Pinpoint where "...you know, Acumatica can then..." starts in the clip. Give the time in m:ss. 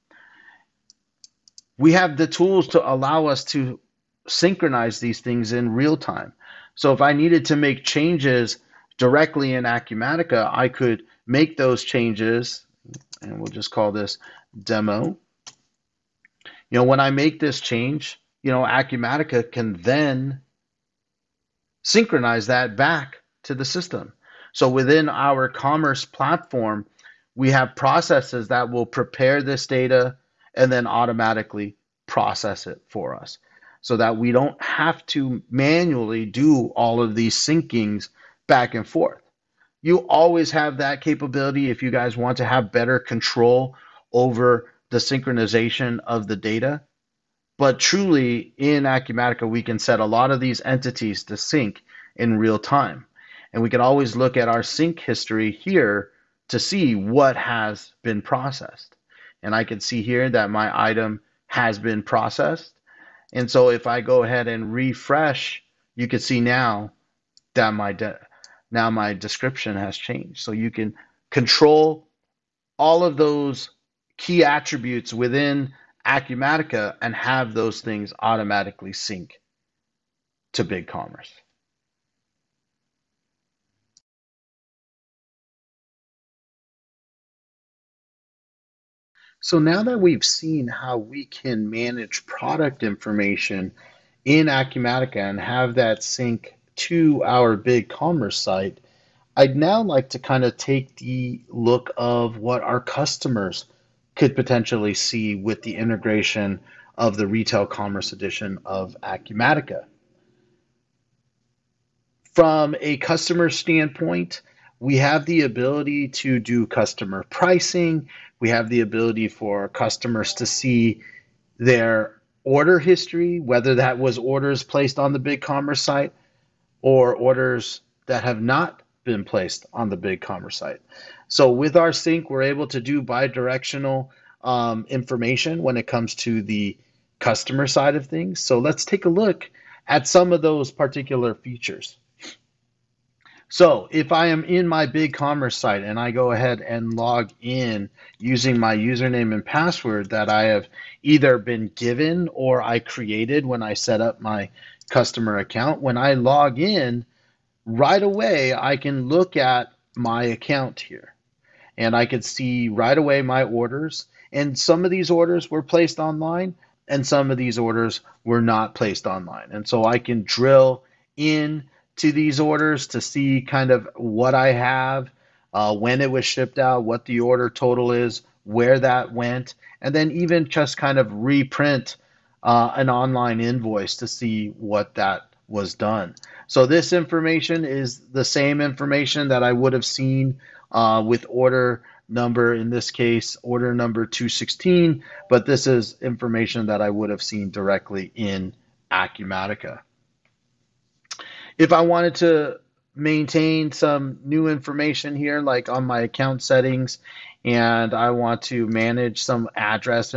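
0:18.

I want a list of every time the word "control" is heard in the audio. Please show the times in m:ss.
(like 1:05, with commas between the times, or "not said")
0:42, 1:11.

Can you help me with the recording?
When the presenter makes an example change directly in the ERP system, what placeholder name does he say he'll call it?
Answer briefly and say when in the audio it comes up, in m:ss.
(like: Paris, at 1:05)
demo, at 0:14.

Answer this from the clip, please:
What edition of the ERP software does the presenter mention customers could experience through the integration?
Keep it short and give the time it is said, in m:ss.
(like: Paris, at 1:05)
retail commerce edition, at 1:47.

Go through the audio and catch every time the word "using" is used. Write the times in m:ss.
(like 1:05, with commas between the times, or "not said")
2:28.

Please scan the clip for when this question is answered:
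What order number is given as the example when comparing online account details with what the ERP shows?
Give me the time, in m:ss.
3:14.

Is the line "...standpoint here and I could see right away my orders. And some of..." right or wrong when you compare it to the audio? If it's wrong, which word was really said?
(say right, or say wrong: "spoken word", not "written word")
wrong: "account", not "standpoint".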